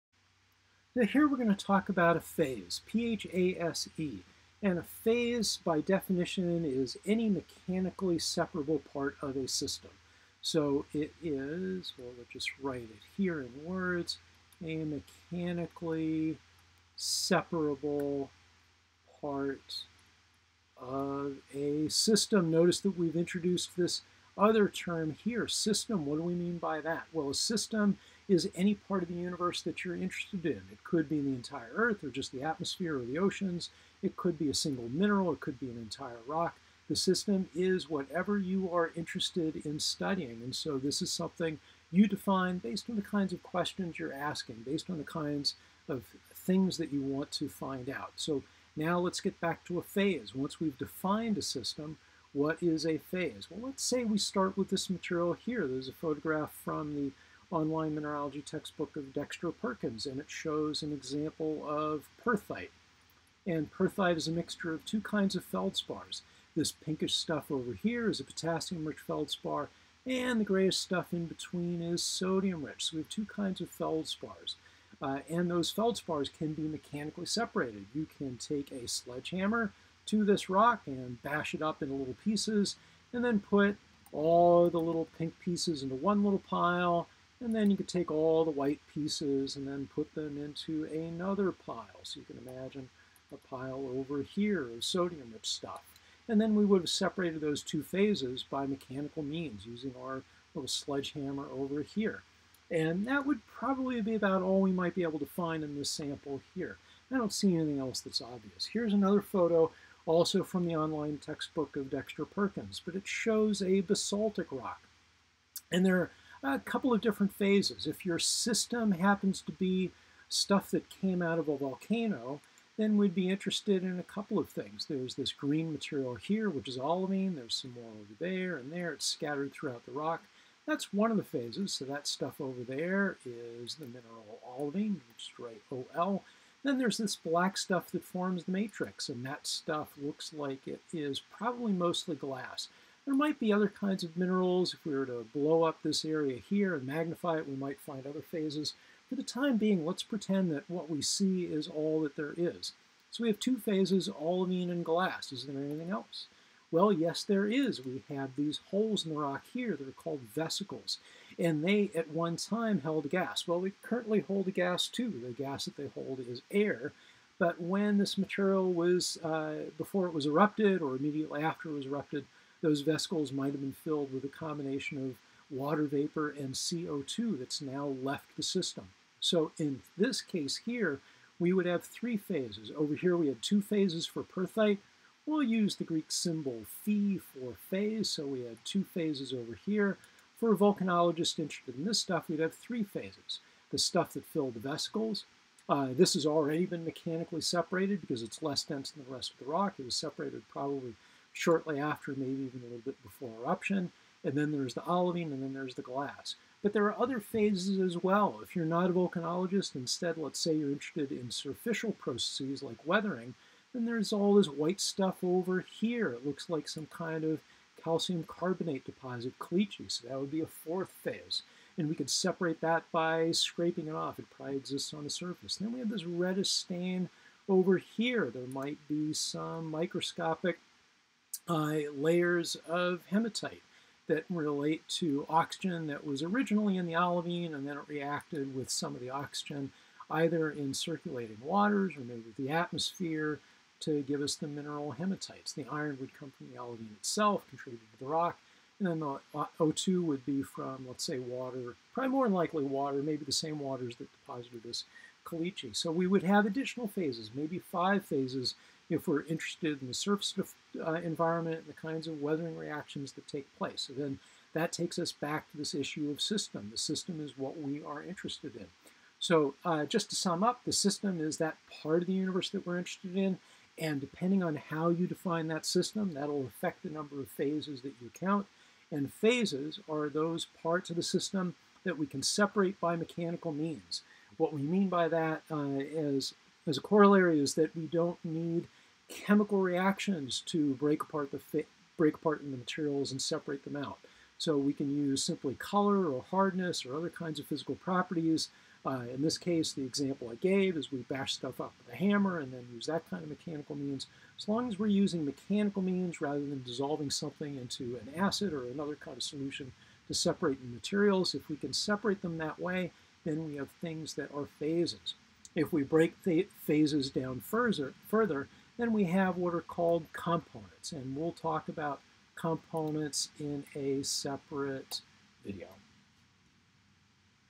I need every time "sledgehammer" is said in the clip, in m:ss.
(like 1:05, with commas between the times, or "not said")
1:18, 1:40.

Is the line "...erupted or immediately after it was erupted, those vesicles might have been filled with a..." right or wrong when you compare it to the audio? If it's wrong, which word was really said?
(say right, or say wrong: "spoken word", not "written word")
right.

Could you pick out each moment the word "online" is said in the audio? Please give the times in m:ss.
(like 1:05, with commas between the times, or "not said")
0:57, 1:50.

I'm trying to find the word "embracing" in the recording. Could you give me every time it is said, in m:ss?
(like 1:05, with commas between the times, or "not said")
not said.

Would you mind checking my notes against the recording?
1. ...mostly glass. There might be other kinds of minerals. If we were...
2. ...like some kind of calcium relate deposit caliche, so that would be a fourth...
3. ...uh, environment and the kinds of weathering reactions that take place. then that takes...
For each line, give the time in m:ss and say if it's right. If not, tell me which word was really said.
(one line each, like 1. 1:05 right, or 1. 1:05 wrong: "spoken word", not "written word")
1. 2:21 right
2. 3:36 wrong: "carbonate", not "relate"
3. 4:20 right.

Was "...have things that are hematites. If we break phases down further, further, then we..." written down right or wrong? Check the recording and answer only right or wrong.
wrong.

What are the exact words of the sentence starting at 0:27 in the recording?
Well, a system is any part of the universe that you're interested in.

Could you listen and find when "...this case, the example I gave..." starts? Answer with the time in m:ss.
4:59.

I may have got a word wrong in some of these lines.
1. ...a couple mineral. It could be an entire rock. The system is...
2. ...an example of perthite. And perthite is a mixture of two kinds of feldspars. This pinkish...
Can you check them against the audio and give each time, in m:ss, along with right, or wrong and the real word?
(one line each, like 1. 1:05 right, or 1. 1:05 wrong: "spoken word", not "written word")
1. 0:34 wrong: "single", not "couple"
2. 1:00 right.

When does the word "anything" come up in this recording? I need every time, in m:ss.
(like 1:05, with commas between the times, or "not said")
1:47, 2:35.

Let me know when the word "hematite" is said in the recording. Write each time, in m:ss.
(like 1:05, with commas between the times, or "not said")
3:53, 4:04.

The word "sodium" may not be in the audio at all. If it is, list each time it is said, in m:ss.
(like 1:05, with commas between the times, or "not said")
1:12, 1:34.